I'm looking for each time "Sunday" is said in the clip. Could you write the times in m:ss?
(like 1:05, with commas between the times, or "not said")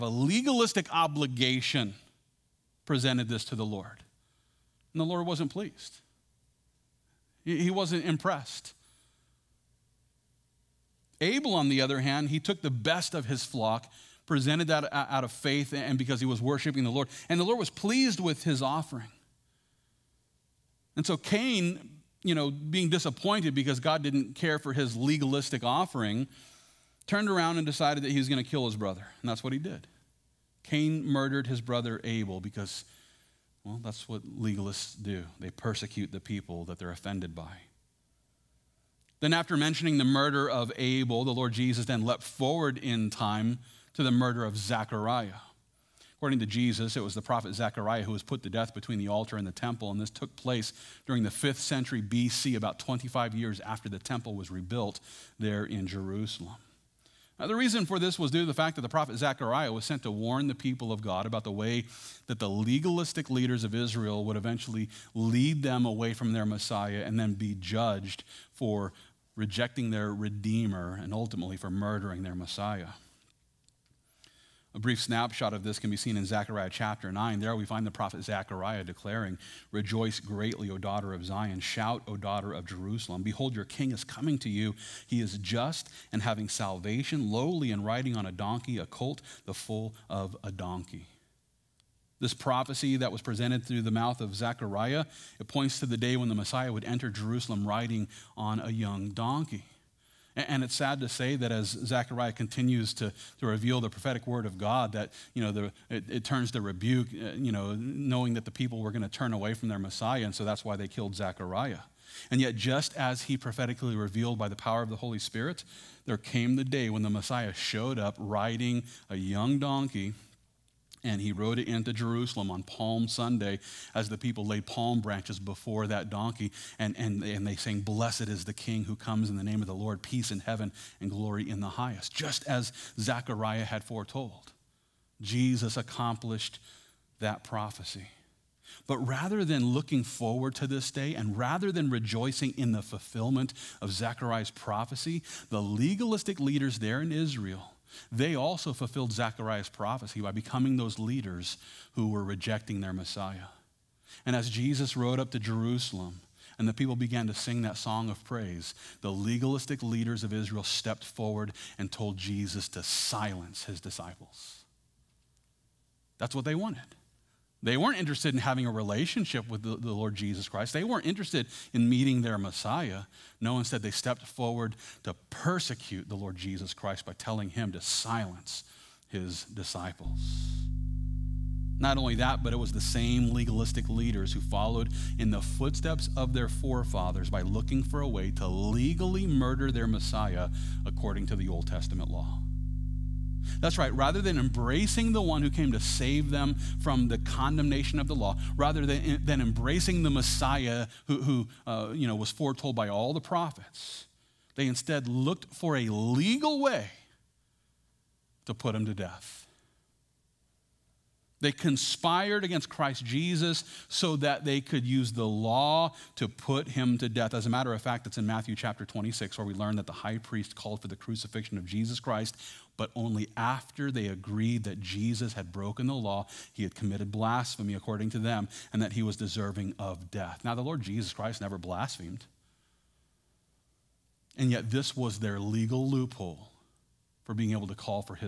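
2:03.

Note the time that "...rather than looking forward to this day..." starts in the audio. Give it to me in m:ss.
2:18.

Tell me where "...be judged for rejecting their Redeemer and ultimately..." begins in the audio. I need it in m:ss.
1:07.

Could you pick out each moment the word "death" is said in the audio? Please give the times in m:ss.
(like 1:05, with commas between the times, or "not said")
0:48, 3:28, 3:37, 3:50.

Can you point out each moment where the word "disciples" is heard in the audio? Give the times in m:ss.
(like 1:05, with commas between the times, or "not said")
2:43, 2:59.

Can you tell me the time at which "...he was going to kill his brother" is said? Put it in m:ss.
0:28.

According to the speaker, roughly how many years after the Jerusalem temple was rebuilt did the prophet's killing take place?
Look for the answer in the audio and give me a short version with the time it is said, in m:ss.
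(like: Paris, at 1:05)
25, at 0:52.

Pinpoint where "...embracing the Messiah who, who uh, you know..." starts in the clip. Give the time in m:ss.
3:19.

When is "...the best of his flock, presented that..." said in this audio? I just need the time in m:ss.
0:12.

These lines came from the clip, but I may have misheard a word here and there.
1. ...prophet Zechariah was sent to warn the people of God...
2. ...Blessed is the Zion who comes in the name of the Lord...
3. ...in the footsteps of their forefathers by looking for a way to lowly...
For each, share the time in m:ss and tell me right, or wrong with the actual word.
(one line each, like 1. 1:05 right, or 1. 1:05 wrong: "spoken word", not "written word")
1. 0:58 right
2. 2:07 wrong: "King", not "Zion"
3. 3:05 wrong: "legally", not "lowly".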